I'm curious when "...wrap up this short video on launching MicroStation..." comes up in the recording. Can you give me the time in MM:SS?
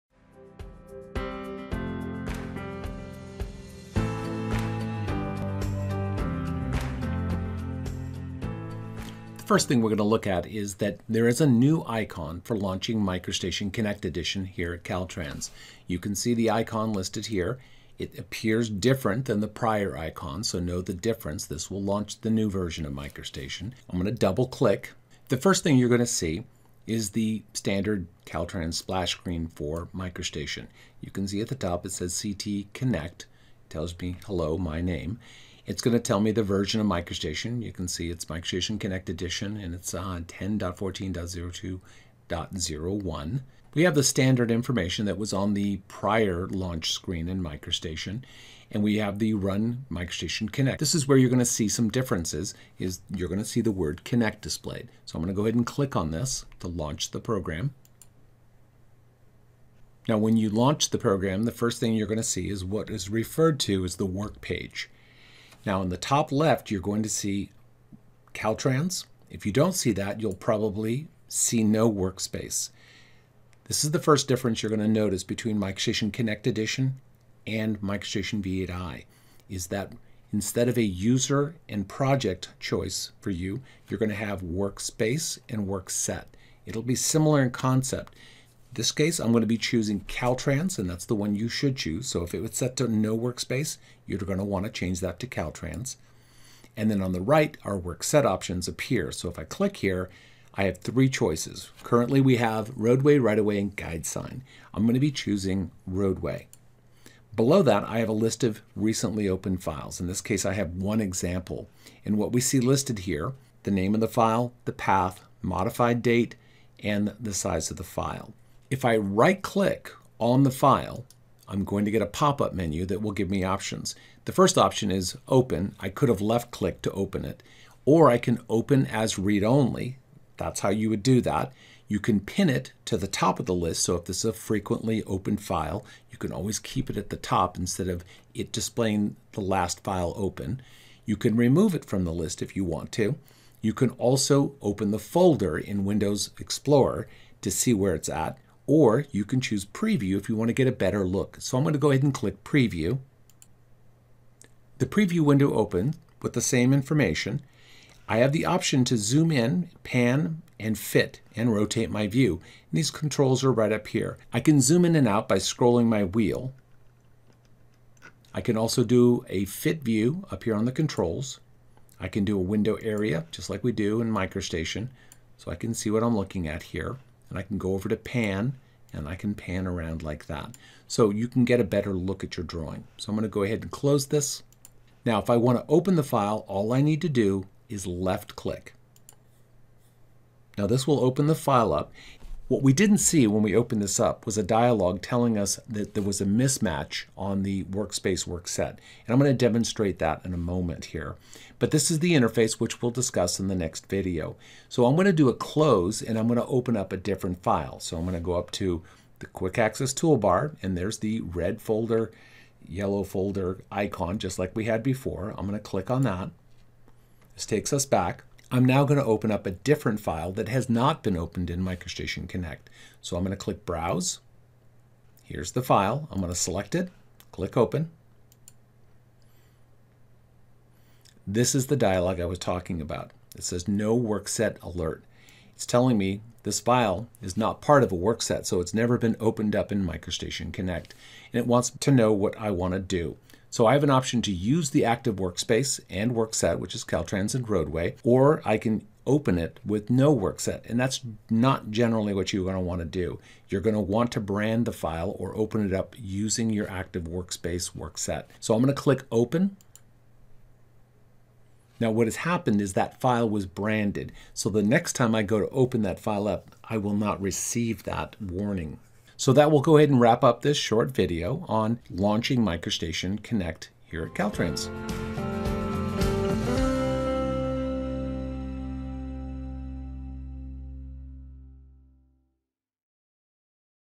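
04:30.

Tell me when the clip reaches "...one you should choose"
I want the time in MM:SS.
01:31.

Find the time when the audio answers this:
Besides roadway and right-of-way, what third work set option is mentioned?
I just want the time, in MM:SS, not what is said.
01:43.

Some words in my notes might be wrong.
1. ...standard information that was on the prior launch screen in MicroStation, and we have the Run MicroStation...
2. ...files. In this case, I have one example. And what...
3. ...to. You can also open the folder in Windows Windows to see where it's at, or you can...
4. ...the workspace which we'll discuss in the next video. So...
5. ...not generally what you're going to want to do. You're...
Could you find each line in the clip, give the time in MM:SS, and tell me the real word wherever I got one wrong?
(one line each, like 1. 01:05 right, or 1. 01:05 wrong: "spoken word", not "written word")
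1. 00:44 right
2. 01:49 right
3. 02:22 wrong: "Explorer", not "Windows"
4. 03:21 wrong: "interface", not "workspace"
5. 04:11 right.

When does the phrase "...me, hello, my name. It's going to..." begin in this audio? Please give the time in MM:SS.
00:33.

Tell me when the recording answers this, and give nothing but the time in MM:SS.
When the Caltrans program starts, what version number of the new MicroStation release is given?
00:40.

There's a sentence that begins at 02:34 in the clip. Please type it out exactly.
The preview window opens with the same information.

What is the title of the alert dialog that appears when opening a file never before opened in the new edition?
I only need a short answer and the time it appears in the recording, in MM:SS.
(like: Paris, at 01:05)
No work set alert, at 03:53.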